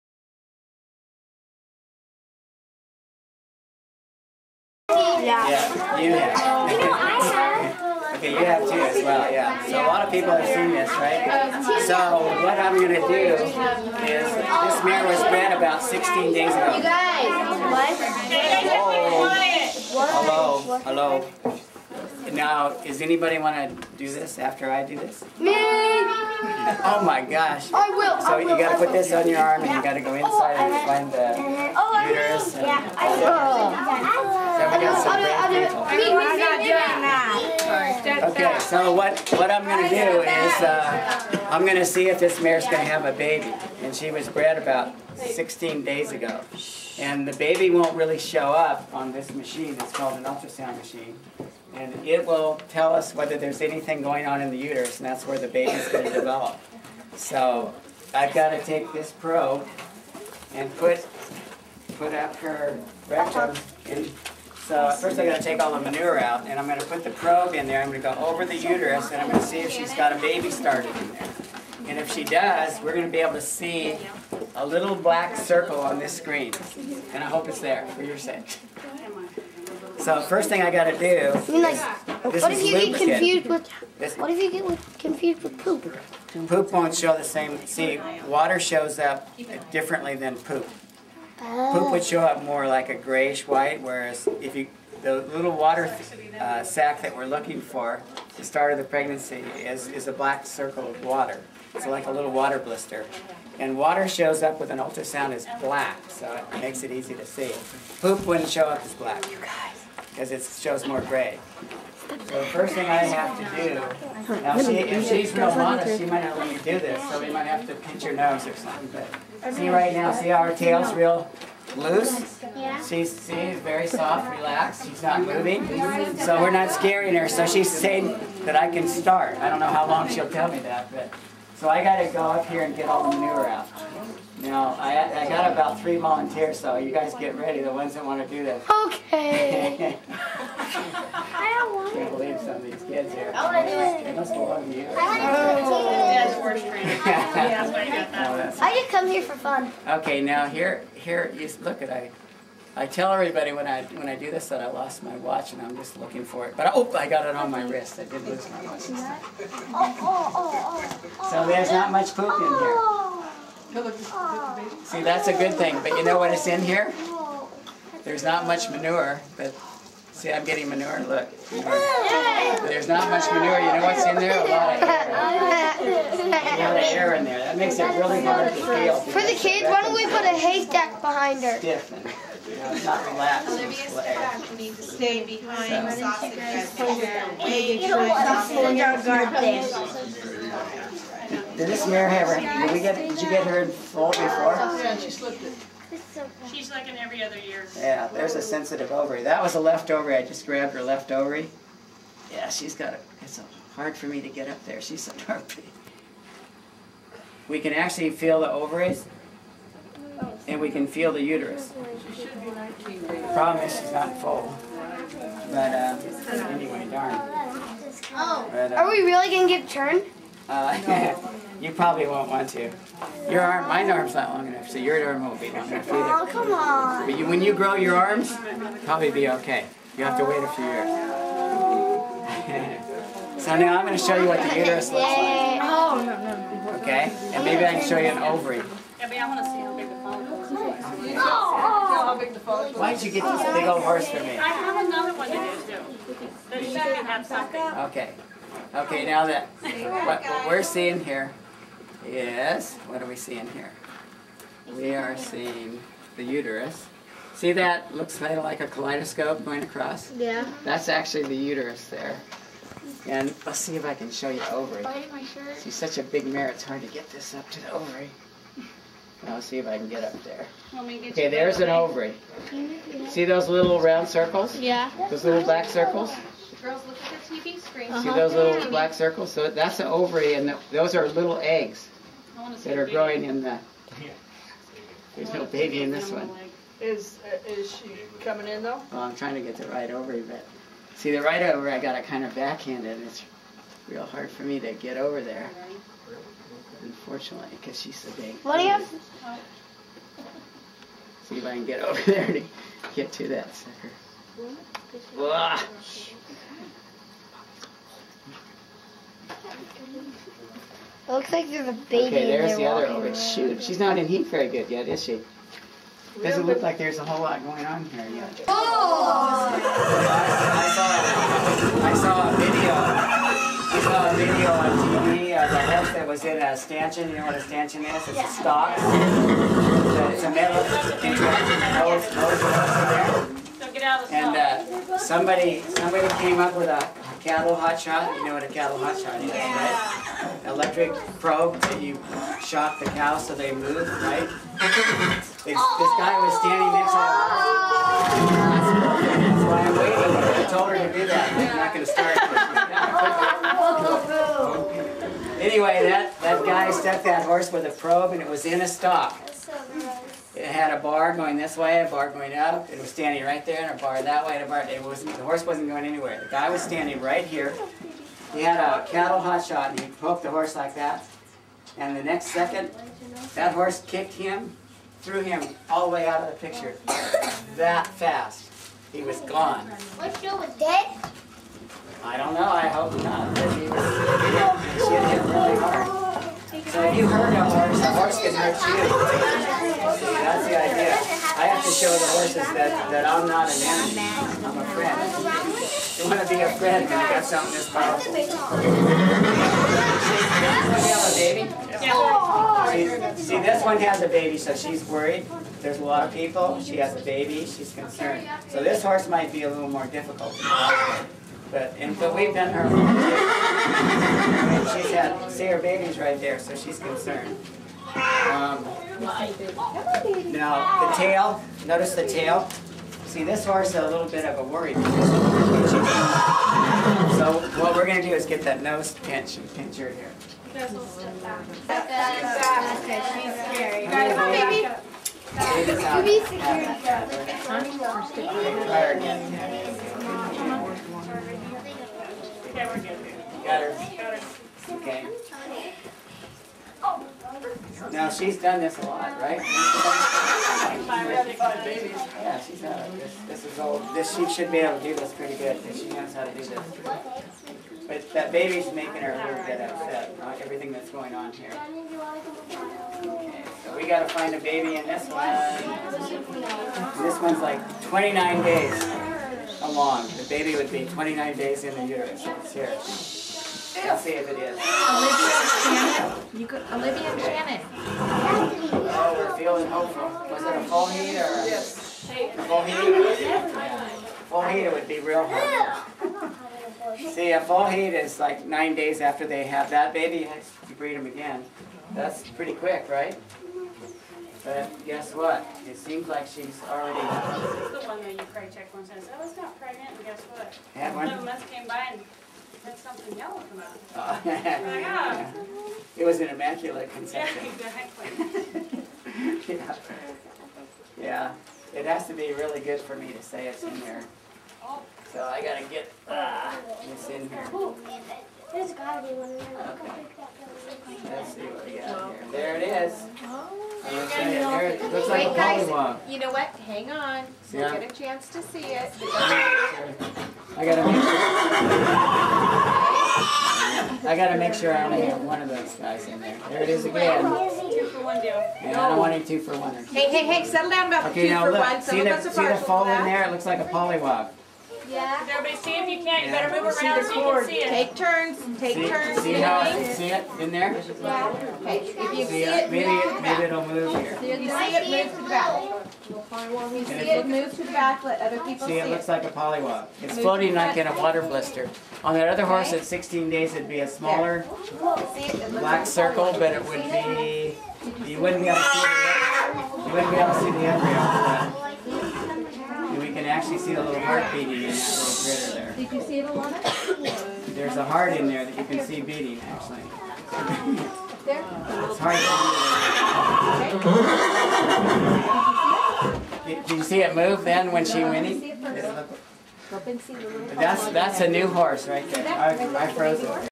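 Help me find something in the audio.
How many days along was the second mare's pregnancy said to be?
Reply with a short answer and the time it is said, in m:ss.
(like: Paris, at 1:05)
29 days, at 7:47.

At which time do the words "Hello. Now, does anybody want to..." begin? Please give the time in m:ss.
0:20.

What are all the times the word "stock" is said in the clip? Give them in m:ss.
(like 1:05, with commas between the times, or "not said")
5:28, 5:58.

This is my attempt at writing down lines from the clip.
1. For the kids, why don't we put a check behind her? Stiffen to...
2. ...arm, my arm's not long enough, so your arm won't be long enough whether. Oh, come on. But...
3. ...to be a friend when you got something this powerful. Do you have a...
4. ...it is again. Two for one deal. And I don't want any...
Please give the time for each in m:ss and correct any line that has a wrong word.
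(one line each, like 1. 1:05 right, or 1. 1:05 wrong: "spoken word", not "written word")
1. 2:59 wrong: "haystack", not "check"
2. 3:43 wrong: "either", not "whether"
3. 6:36 right
4. 8:56 right.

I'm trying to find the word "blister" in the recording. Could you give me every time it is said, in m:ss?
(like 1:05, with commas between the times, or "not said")
1:42, 9:21.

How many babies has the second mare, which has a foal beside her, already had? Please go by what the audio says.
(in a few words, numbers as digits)
5.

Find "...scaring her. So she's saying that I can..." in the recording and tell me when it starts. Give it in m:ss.
2:06.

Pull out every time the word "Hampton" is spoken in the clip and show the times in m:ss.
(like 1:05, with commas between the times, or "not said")
not said.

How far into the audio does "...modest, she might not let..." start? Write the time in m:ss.
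1:55.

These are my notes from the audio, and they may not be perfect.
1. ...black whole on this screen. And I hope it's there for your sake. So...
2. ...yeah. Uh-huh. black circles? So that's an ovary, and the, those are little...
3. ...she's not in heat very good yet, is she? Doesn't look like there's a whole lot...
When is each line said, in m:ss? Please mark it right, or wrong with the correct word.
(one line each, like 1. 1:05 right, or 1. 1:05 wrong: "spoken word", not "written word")
1. 1:14 wrong: "circle", not "whole"
2. 4:38 right
3. 5:13 right.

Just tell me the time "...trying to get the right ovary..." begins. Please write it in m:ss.
4:49.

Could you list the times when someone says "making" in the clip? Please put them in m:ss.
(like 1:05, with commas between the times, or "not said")
7:38.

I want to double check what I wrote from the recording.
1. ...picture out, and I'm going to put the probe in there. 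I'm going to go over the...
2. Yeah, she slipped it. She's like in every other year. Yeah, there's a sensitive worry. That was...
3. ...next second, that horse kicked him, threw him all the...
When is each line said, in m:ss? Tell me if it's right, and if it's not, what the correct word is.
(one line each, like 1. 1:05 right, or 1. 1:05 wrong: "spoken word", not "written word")
1. 1:05 wrong: "manure", not "picture"
2. 3:14 wrong: "ovary", not "worry"
3. 6:12 right.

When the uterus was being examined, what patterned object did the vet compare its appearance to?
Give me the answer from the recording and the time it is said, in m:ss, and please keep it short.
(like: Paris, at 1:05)
kaleidoscope, at 4:18.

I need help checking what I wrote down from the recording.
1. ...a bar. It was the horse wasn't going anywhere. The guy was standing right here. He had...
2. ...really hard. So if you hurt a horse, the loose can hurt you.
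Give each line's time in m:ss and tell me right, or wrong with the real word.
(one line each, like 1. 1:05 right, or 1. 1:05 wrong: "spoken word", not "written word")
1. 6:04 right
2. 6:25 wrong: "horse", not "loose".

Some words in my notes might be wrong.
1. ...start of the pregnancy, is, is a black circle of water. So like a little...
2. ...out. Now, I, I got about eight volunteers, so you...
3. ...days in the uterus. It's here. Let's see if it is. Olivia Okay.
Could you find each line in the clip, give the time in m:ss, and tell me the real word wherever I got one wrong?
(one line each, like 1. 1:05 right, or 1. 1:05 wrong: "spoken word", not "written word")
1. 1:38 right
2. 2:13 wrong: "three", not "eight"
3. 7:51 wrong: "Shannon", not "Okay".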